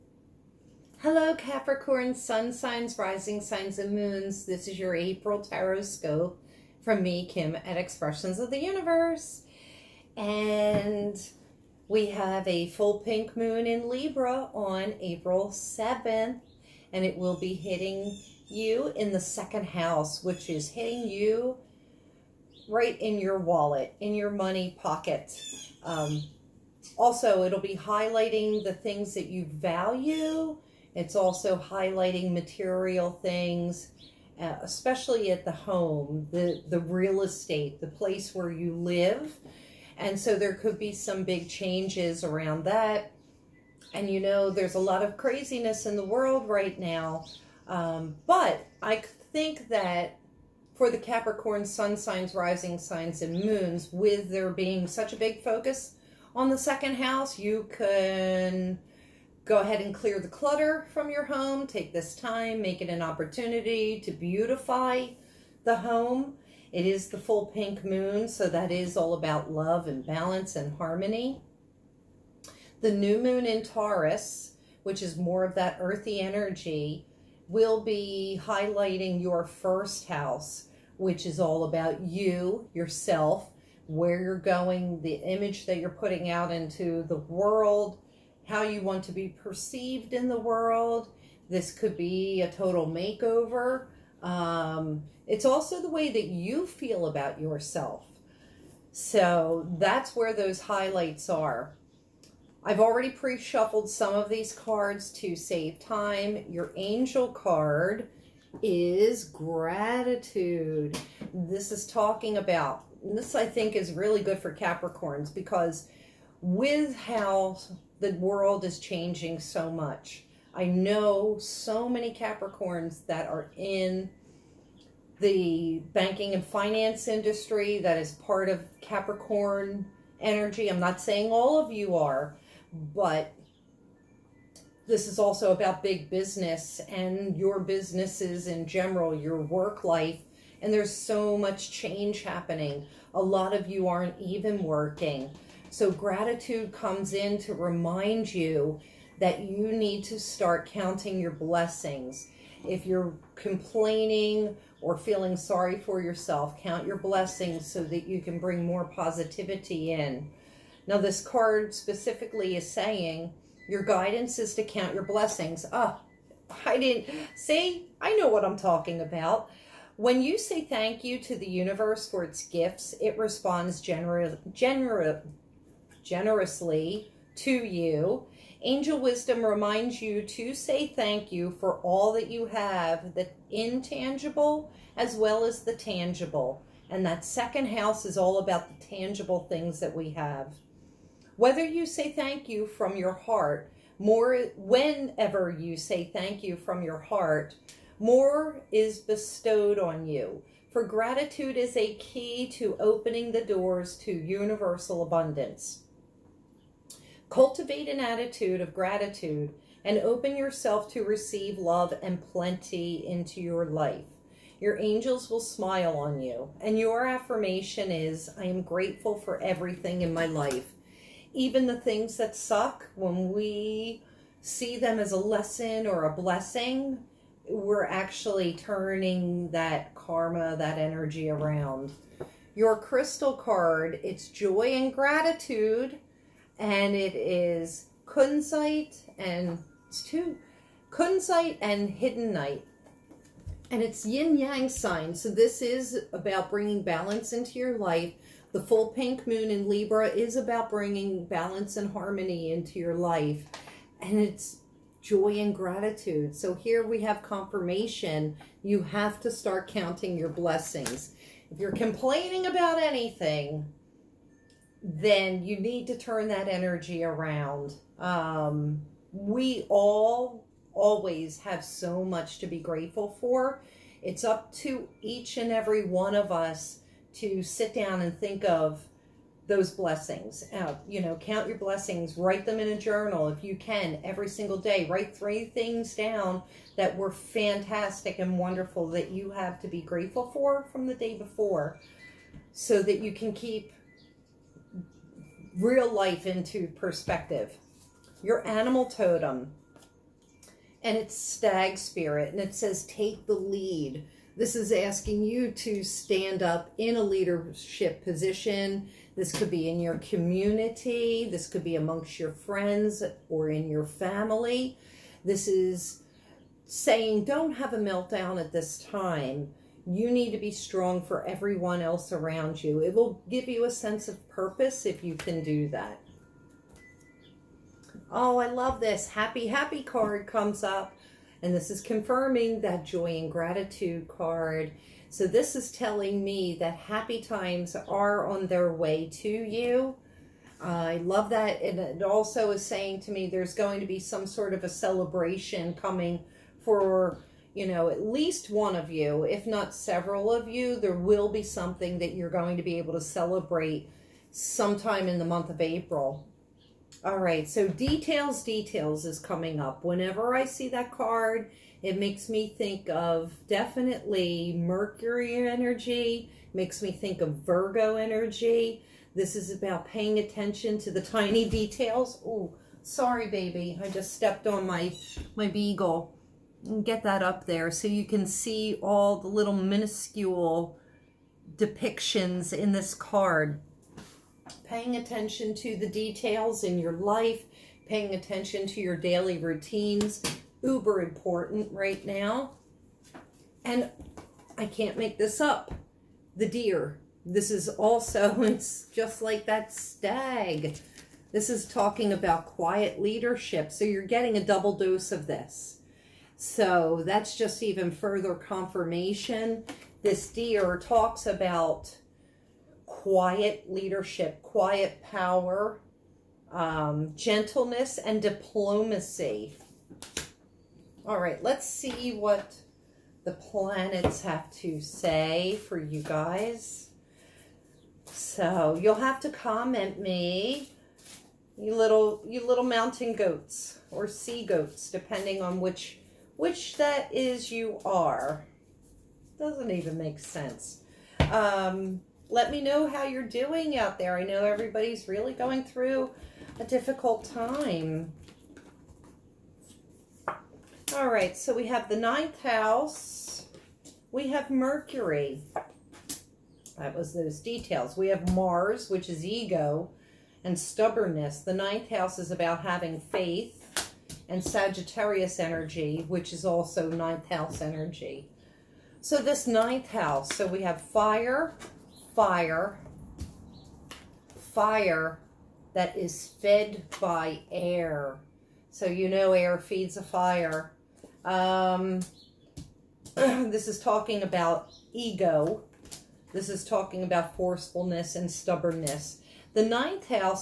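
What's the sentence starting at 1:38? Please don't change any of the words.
So that's where those highlights are.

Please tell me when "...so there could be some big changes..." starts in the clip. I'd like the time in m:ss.
0:40.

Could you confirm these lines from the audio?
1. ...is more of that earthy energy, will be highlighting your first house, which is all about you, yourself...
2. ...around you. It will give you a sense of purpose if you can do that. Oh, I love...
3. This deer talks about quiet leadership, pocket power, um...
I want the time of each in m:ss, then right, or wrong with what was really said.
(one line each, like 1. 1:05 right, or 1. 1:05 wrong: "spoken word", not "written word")
1. 1:15 right
2. 5:22 right
3. 6:50 wrong: "quiet", not "pocket".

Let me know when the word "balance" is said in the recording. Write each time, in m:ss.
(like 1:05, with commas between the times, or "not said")
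1:10, 4:06, 4:11.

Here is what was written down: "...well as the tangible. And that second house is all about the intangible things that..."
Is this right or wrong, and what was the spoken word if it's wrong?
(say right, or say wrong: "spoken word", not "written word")
wrong: "tangible", not "intangible".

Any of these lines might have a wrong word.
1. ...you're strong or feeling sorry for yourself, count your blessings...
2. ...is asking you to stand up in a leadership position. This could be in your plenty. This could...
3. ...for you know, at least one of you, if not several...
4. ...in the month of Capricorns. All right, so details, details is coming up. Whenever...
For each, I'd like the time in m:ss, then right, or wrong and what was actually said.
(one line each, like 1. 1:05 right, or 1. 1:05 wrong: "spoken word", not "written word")
1. 2:32 wrong: "complaining", not "strong"
2. 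5:04 wrong: "community", not "plenty"
3. 5:46 right
4. 5:55 wrong: "April", not "Capricorns".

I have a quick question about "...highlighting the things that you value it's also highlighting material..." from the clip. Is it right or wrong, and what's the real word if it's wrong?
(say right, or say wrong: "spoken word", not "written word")
right.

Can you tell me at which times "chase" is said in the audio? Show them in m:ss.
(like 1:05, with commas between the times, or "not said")
not said.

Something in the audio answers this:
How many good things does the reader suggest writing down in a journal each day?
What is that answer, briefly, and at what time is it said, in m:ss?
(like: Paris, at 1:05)
3, at 4:45.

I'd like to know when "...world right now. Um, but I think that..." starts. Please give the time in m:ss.
0:46.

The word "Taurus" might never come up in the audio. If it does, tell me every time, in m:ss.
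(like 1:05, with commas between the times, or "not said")
1:13.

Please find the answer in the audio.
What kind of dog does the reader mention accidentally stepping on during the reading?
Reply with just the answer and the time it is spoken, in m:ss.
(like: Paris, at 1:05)
Beagle, at 6:15.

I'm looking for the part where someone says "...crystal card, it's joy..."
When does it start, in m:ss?
3:52.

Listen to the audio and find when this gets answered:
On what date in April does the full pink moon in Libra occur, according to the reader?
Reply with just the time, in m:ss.
0:15.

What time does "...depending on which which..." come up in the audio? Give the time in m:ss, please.
7:14.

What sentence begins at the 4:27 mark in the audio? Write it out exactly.
Um, we all always have so much to be grateful for.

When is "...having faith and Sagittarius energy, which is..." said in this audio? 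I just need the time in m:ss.
7:42.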